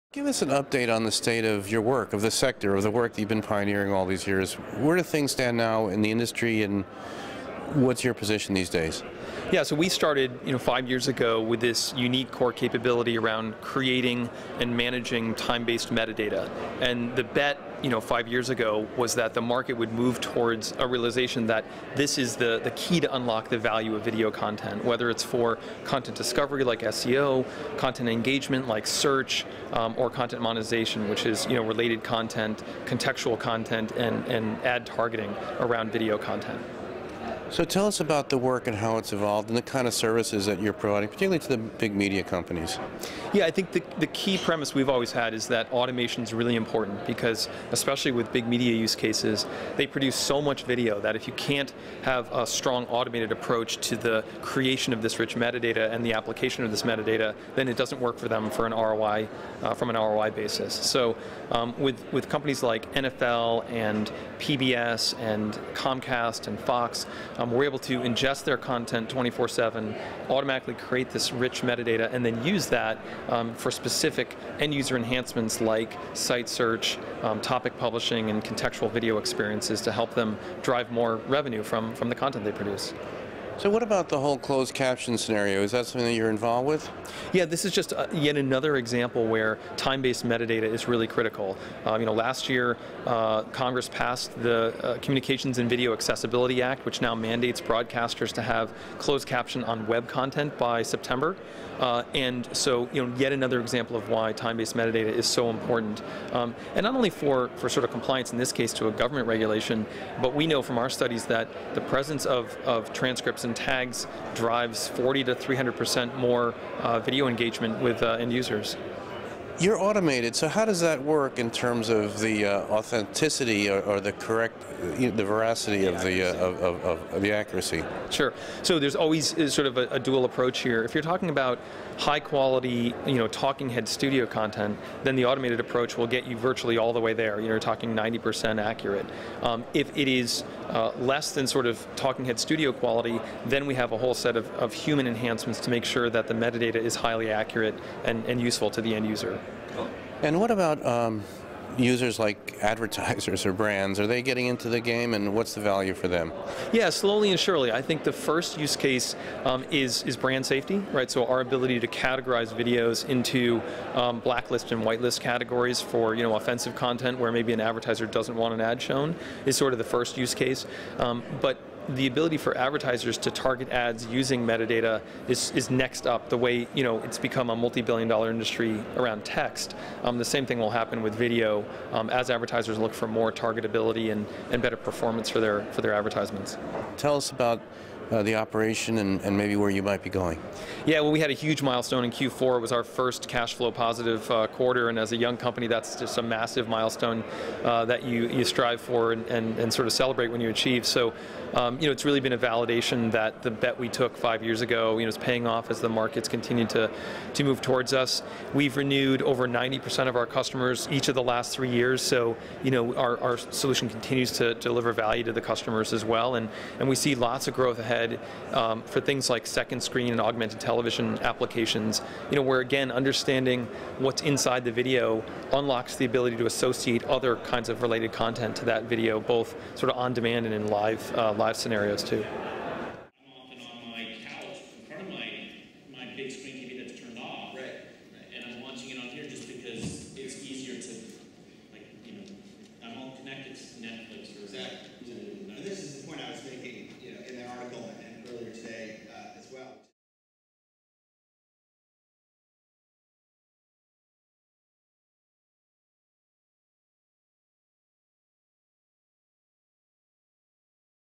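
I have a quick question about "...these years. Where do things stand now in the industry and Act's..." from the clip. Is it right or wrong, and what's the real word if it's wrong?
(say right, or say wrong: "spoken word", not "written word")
wrong: "What", not "Act".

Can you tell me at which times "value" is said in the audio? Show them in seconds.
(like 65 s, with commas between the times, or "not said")
23 s, 155 s, 214 s.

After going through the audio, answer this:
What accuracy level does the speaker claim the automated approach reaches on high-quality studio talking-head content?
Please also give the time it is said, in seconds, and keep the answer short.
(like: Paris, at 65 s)
90%, at 137 s.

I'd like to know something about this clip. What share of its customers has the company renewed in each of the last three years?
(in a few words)
over 90%.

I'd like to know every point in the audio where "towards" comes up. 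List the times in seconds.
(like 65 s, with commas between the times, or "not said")
20 s, 207 s.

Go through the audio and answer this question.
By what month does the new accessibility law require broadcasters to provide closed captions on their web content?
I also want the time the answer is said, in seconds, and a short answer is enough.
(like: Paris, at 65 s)
September, at 100 s.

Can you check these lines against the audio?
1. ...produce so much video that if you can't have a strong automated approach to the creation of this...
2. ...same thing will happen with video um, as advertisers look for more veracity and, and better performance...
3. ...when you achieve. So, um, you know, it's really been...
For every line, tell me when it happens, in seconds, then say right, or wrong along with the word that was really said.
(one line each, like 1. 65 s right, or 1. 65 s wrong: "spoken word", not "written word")
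1. 49 s right
2. 180 s wrong: "targetability", not "veracity"
3. 200 s right.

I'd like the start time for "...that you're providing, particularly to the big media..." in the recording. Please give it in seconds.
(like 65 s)
40 s.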